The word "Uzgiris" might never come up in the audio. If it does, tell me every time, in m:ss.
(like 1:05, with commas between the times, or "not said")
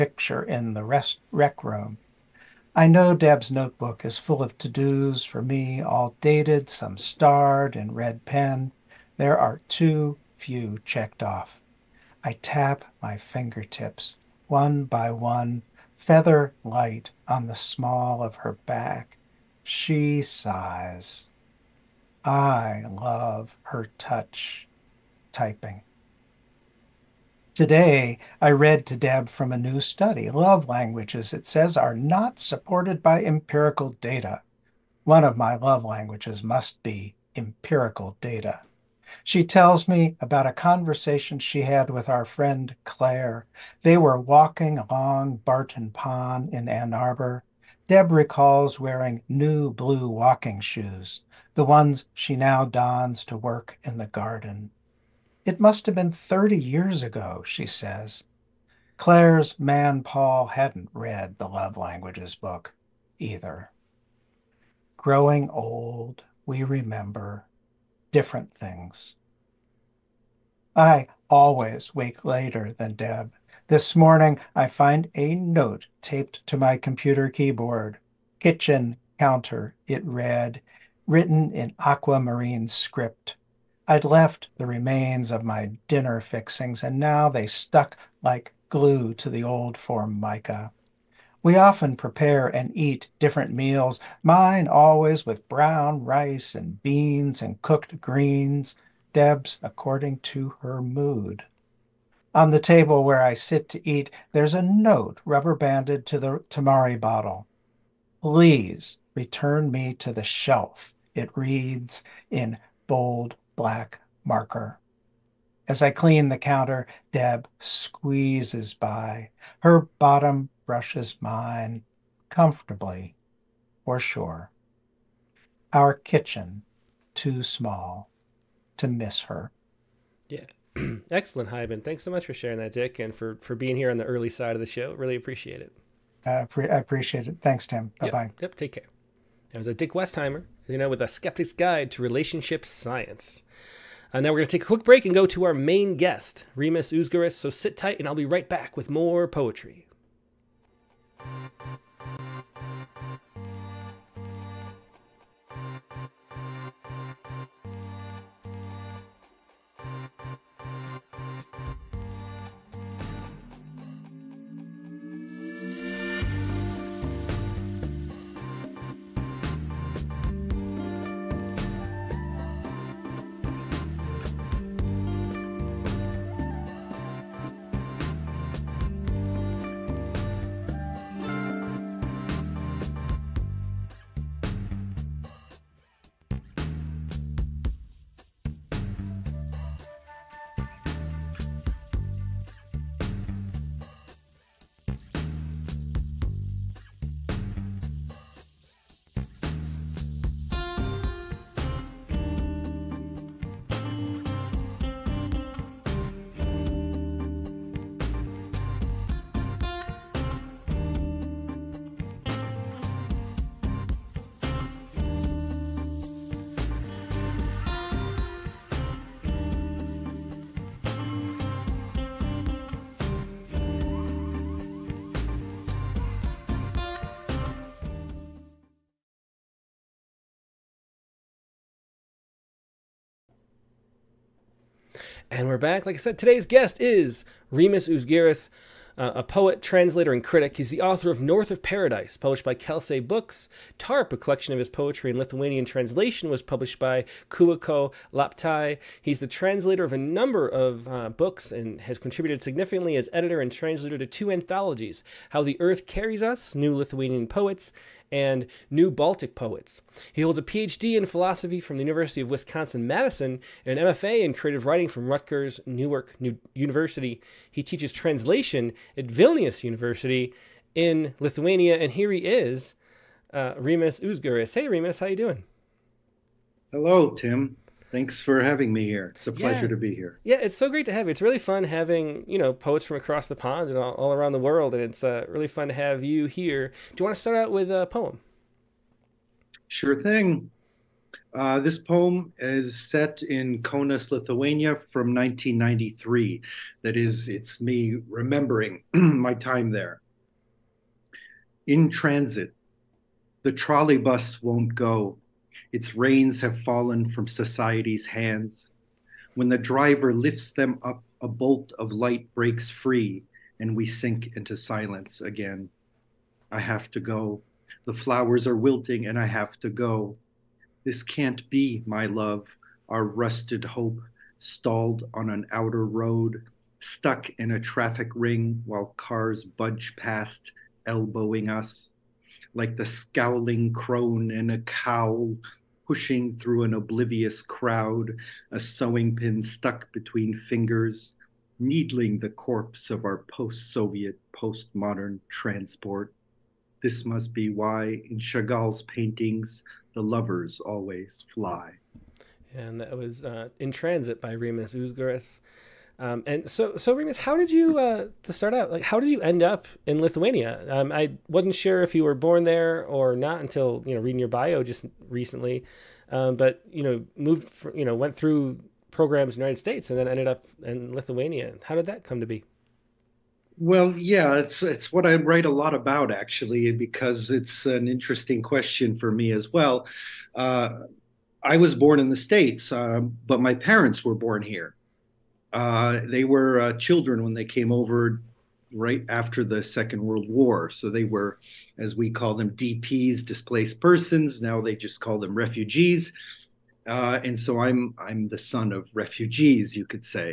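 3:57, 4:34, 5:54.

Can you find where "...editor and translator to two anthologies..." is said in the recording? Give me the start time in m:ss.
4:13.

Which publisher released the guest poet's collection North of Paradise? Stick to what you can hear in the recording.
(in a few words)
Kelsay Books.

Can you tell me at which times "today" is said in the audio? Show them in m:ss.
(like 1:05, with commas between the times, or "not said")
0:27, 3:56.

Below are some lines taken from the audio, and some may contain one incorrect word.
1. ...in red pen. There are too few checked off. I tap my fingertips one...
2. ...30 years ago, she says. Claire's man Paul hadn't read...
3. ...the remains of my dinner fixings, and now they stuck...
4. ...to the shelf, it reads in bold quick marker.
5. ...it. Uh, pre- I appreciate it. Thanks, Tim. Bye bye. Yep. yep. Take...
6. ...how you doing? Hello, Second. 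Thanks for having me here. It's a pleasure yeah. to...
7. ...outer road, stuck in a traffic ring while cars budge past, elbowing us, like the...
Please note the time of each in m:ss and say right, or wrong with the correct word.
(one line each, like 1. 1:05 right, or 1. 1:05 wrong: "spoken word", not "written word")
1. 0:07 right
2. 0:56 right
3. 1:24 right
4. 1:49 wrong: "black", not "quick"
5. 2:15 right
6. 4:35 wrong: "Tim", not "Second"
7. 5:25 right.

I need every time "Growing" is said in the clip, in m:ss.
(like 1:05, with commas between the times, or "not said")
1:04.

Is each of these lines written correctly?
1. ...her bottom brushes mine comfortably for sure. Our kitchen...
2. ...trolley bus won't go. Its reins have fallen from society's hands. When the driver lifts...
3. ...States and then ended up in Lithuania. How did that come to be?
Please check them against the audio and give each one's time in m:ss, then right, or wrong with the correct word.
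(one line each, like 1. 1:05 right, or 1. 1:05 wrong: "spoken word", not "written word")
1. 1:59 right
2. 5:03 right
3. 6:09 right.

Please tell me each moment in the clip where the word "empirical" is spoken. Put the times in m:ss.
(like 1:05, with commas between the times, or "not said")
0:33, 0:37.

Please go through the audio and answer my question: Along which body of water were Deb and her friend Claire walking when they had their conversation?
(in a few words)
Barton Pond.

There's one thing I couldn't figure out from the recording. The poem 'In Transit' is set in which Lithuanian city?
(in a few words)
Kaunas.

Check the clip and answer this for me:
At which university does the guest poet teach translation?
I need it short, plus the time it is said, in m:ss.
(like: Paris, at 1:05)
Vilnius University, at 4:29.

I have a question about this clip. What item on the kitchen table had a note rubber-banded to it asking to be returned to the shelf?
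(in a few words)
tamari bottle.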